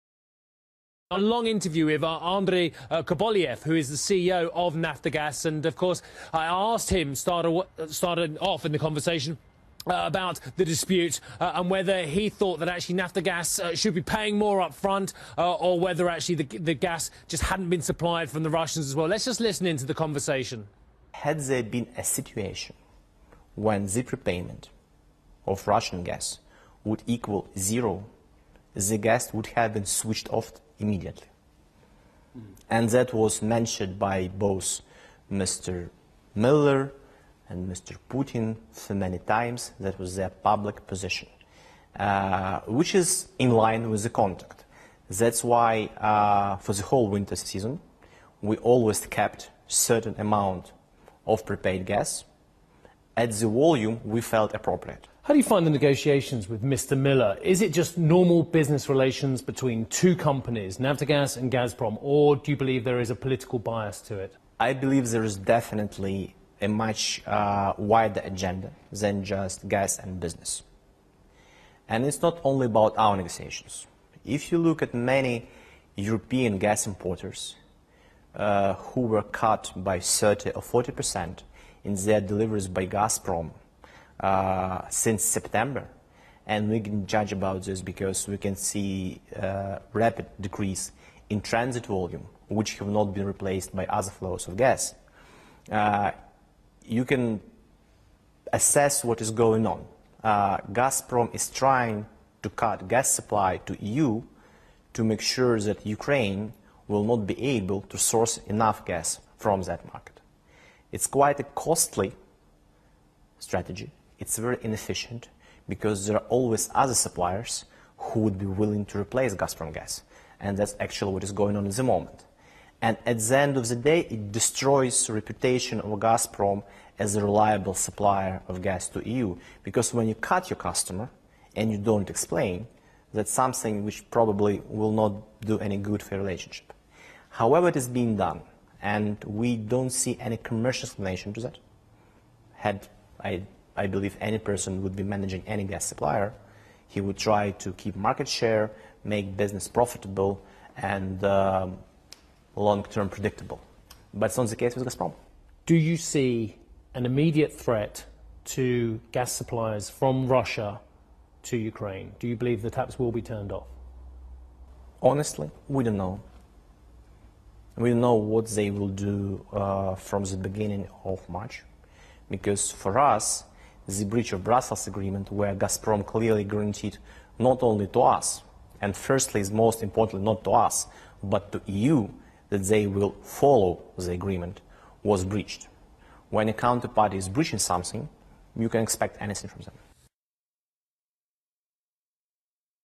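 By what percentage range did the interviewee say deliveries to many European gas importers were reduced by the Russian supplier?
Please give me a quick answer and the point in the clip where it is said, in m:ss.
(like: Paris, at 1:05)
30 or 40 percent, at 1:19.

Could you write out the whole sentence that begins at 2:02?
And at the end of the day, it destroys reputation of Gazprom as a reliable supplier of gas to EU.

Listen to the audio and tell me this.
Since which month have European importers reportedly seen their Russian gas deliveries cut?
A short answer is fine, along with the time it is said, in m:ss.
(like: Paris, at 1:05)
September, at 1:25.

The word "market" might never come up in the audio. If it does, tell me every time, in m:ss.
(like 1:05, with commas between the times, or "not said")
1:49, 2:27.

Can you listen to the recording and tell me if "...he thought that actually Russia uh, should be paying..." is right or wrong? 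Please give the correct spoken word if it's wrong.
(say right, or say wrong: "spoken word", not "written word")
wrong: "Naftogaz", not "Russia".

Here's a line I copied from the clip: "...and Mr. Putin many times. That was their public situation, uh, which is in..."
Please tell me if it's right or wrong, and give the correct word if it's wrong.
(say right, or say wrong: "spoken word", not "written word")
wrong: "position", not "situation".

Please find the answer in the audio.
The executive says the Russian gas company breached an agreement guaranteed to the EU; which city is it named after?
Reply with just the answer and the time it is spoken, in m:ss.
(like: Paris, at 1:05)
Brussels, at 2:54.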